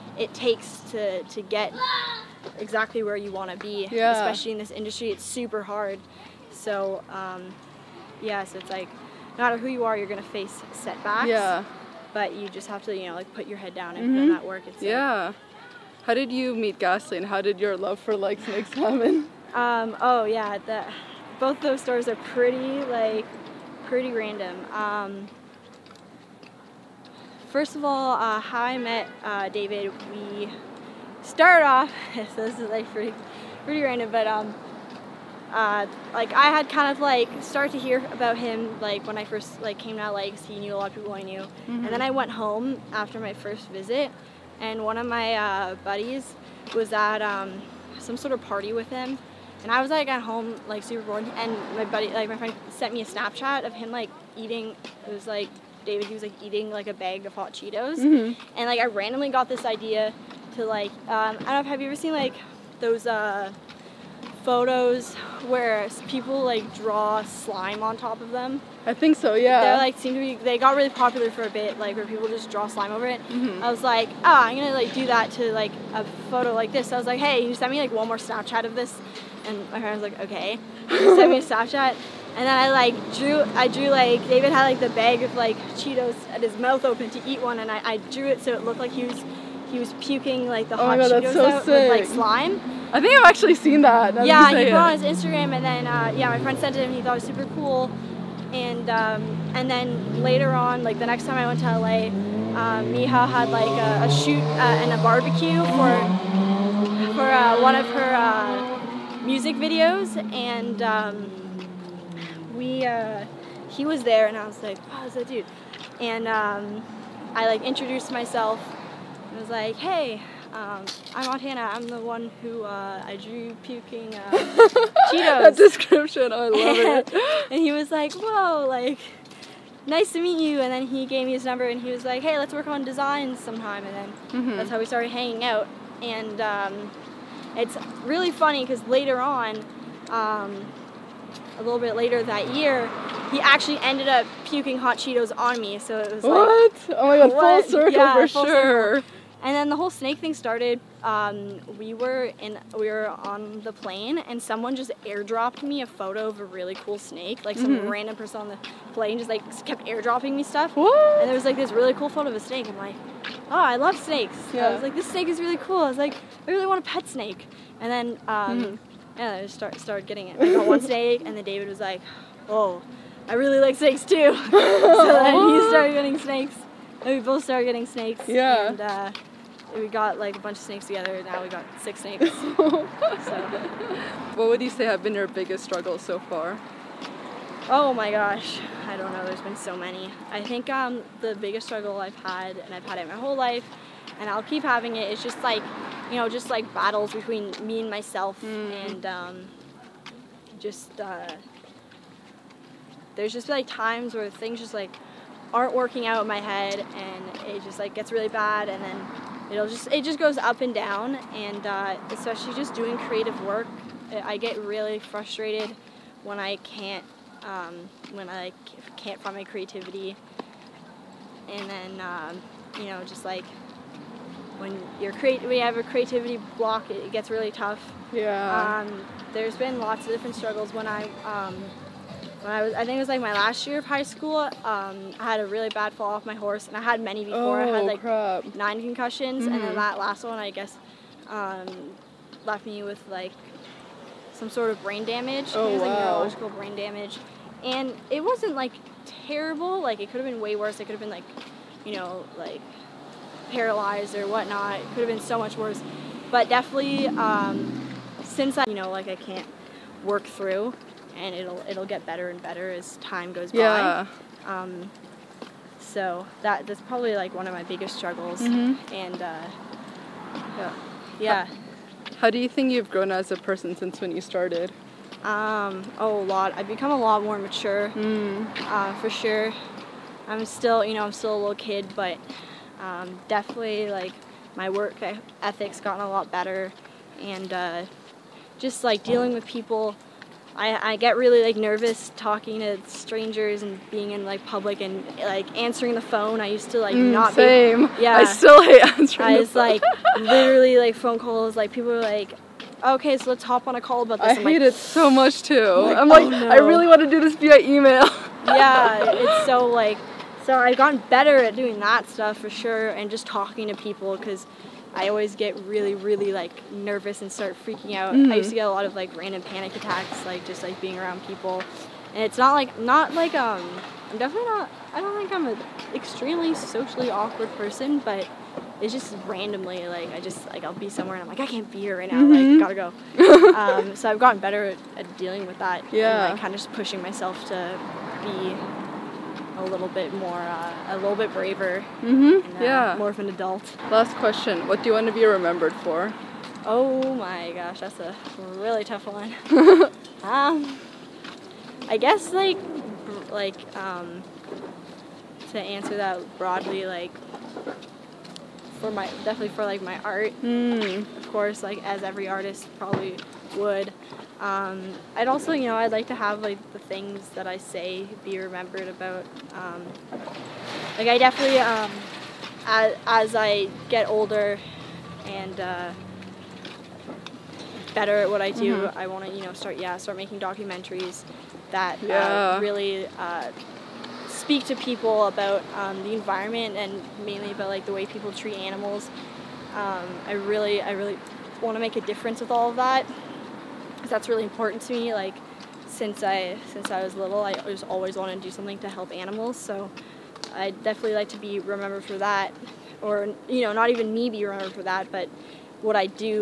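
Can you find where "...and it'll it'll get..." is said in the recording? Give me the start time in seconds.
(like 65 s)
261 s.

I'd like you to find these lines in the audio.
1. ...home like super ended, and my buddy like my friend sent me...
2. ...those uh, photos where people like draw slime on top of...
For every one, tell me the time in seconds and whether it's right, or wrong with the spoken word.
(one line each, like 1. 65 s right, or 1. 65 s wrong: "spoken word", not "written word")
1. 50 s wrong: "bored", not "ended"
2. 62 s right.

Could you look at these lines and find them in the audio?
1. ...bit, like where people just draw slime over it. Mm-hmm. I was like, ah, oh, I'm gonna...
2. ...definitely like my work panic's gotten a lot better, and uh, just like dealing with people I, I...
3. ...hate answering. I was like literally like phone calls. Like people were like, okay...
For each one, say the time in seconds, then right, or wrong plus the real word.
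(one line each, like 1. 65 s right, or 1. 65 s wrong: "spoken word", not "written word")
1. 71 s right
2. 283 s wrong: "ethic", not "panic"
3. 298 s right.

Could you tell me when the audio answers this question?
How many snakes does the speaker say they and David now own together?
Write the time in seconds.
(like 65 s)
181 s.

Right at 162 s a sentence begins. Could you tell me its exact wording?
I'm like, oh, I love snakes.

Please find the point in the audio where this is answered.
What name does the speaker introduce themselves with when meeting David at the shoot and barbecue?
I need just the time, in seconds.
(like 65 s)
121 s.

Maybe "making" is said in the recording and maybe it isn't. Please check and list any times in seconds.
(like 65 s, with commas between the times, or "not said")
380 s.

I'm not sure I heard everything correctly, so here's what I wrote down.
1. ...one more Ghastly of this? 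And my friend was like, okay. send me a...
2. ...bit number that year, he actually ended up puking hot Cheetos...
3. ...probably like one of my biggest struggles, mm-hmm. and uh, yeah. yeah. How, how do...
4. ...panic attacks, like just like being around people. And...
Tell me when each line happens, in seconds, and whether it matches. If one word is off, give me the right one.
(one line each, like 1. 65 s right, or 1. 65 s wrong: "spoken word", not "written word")
1. 77 s wrong: "Snapchat", not "Ghastly"
2. 141 s wrong: "later", not "number"
3. 266 s right
4. 319 s right.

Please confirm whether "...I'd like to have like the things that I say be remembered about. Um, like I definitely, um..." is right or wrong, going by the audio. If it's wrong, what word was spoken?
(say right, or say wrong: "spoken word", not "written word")
right.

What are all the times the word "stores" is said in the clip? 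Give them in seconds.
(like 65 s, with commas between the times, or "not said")
21 s.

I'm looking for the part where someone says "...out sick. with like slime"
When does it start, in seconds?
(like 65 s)
91 s.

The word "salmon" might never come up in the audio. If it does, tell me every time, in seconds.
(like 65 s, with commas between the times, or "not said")
18 s.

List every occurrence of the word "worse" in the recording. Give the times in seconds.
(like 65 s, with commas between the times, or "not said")
250 s, 255 s.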